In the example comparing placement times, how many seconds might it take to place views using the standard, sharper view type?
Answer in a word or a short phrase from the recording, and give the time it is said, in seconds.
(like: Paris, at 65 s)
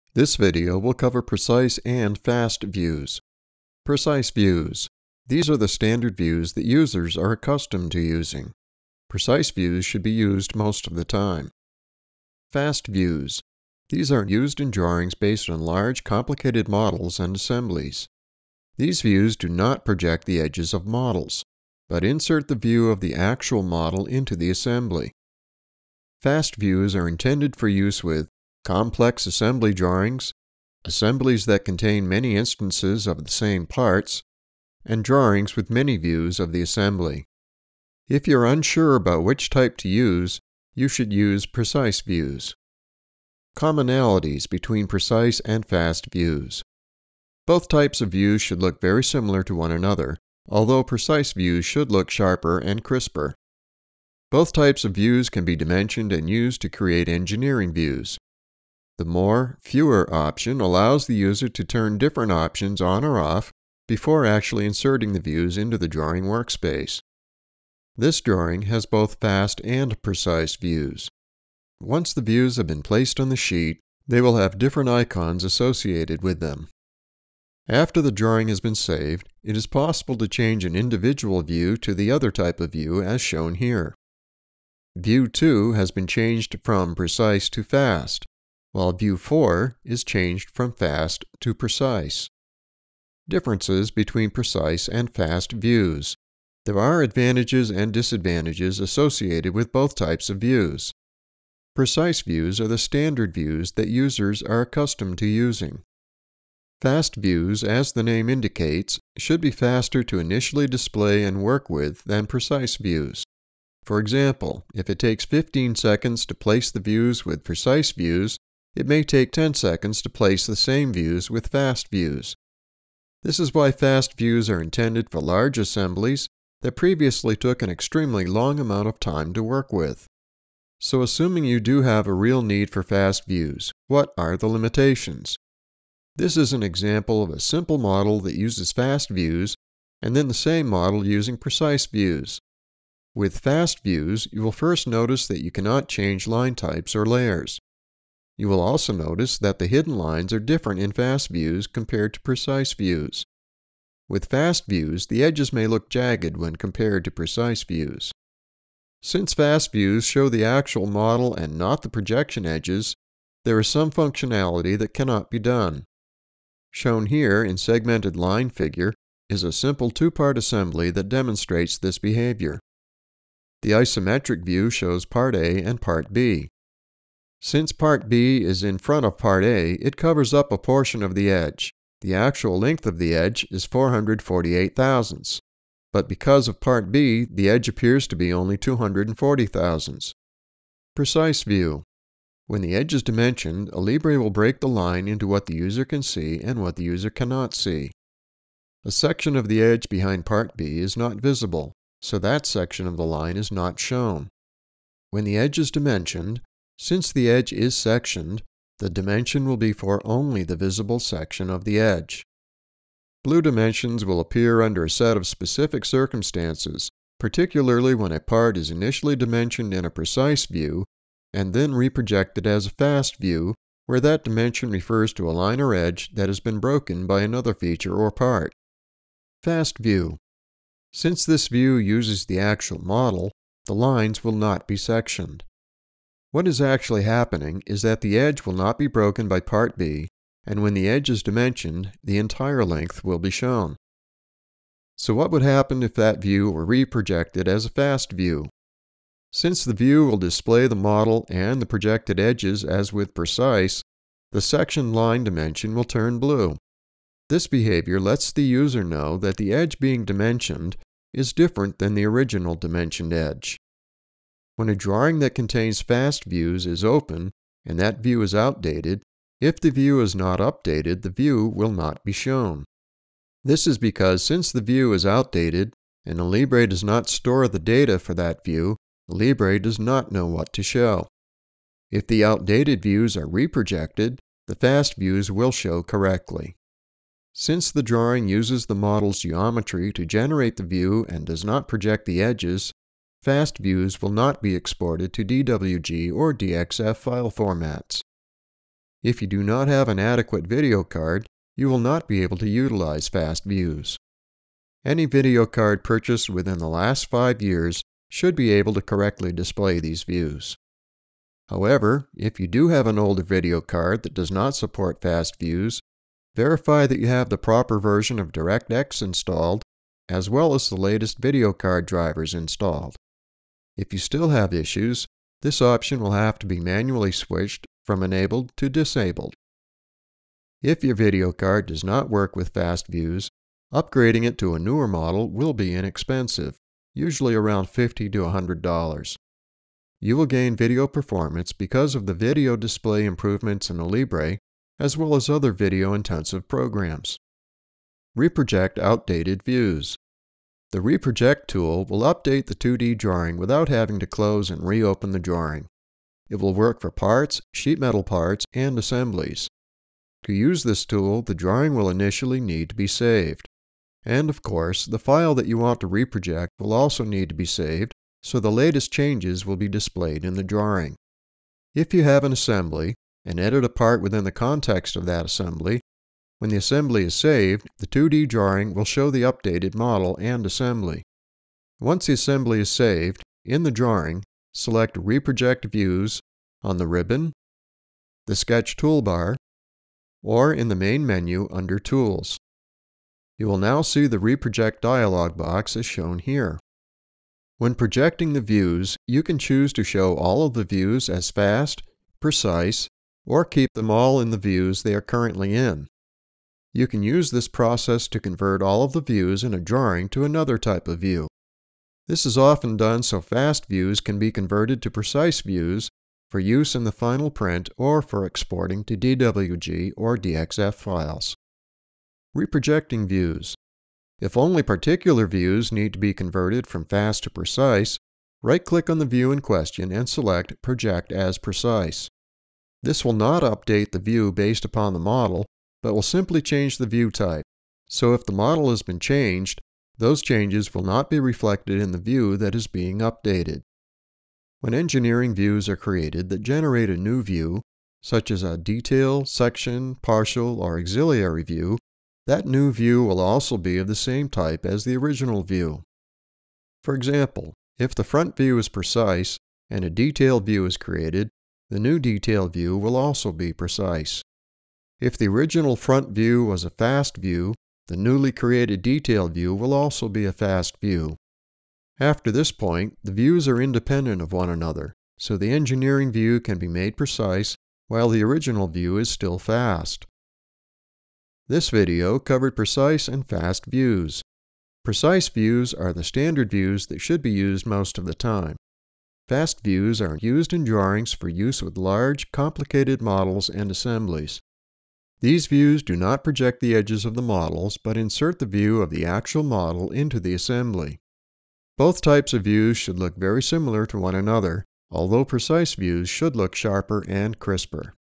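15, at 115 s.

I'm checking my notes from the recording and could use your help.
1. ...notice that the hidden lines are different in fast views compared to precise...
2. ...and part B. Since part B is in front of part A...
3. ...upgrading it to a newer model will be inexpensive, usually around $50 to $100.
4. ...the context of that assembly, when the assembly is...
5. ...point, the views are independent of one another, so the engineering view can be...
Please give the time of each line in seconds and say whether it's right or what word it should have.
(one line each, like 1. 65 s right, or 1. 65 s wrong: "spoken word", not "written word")
1. 148 s right
2. 175 s right
3. 333 s right
4. 374 s right
5. 472 s right.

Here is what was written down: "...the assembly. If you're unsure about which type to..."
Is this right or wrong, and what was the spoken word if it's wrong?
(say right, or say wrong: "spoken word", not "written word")
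right.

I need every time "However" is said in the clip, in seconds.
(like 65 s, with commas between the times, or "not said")
311 s.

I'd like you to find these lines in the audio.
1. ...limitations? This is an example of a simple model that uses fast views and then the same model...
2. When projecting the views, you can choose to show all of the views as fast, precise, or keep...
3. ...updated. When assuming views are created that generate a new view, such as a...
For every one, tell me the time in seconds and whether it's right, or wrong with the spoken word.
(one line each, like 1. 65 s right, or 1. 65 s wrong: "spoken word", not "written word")
1. 134 s right
2. 397 s right
3. 442 s wrong: "engineering", not "assuming".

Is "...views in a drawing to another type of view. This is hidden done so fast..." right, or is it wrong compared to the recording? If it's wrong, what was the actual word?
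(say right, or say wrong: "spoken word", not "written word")
wrong: "often", not "hidden".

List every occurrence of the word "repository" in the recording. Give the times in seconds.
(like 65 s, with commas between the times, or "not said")
not said.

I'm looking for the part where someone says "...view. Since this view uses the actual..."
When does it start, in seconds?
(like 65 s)
229 s.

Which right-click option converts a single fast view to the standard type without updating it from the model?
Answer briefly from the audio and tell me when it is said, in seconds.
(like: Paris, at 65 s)
Project as Precise, at 430 s.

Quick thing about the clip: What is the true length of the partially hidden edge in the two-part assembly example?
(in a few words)
448 thousandths.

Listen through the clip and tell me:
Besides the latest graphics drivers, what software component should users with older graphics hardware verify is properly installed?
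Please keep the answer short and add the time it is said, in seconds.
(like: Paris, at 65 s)
DirectX, at 318 s.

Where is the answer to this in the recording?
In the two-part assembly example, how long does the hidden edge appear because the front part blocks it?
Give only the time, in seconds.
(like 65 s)
188 s.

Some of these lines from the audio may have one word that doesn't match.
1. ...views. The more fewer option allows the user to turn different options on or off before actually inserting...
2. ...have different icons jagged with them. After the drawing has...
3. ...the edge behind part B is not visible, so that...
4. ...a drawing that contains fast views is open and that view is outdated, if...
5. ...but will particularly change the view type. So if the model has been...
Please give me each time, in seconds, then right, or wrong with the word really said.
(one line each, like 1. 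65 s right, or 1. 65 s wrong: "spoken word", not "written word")
1. 57 s right
2. 74 s wrong: "associated", not "jagged"
3. 199 s right
4. 264 s right
5. 435 s wrong: "simply", not "particularly".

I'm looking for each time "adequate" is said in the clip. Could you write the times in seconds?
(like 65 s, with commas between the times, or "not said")
299 s.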